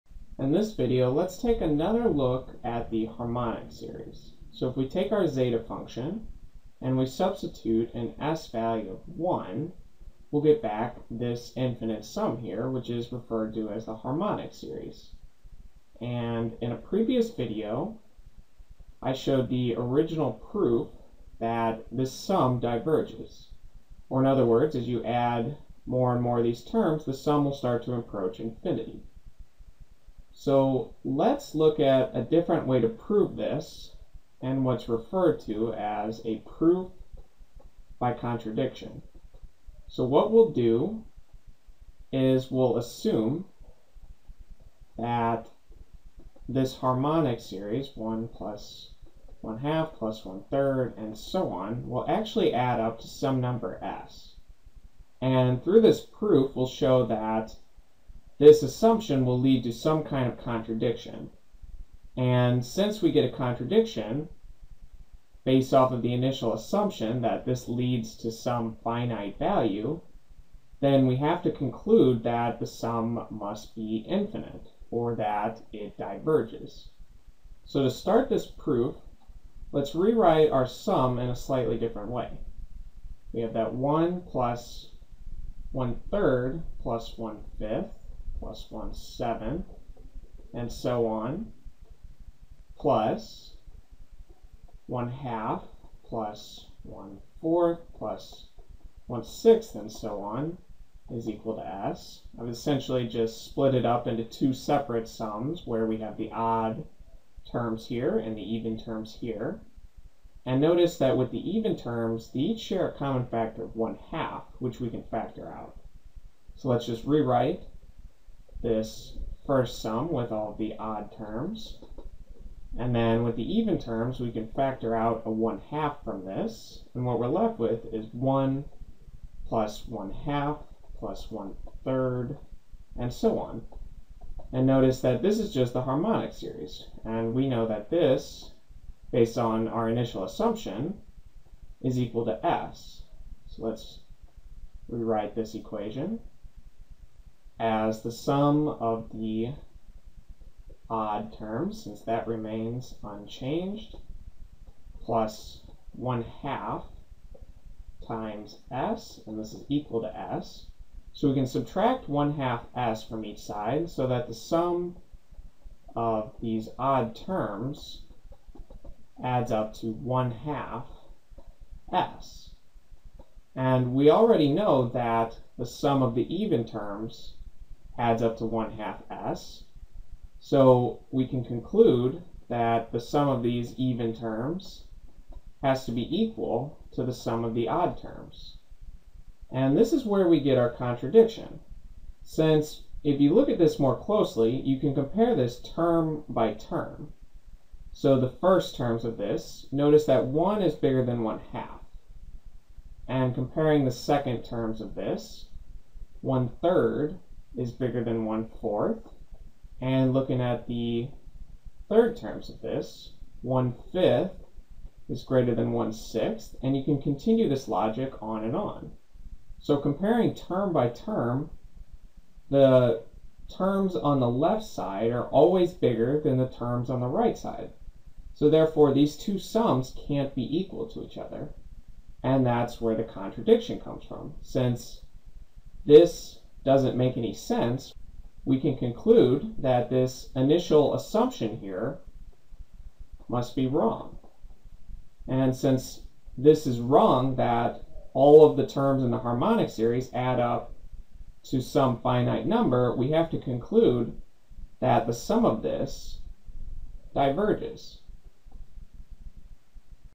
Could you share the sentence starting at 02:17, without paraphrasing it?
And we know that this, based on our initial assumption, is equal to s.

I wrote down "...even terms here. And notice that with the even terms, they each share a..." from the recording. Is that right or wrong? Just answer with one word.
right.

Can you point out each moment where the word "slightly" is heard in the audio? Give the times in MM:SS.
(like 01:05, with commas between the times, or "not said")
01:21.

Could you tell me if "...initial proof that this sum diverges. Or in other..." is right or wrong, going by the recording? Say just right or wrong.
wrong.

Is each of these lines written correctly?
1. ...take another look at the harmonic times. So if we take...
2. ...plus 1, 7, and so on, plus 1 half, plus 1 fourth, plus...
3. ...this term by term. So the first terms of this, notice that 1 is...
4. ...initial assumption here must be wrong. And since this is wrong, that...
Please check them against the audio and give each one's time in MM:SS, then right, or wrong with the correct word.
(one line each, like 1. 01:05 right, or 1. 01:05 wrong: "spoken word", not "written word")
1. 00:01 wrong: "series", not "times"
2. 01:28 right
3. 03:15 right
4. 04:00 right.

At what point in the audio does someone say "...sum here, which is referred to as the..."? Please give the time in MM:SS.
00:12.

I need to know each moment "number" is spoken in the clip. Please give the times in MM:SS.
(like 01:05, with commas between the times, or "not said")
00:53, 04:12.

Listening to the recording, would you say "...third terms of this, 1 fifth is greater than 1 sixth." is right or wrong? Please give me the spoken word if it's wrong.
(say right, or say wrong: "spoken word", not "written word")
right.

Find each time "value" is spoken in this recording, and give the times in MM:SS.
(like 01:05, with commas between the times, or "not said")
00:08, 01:09.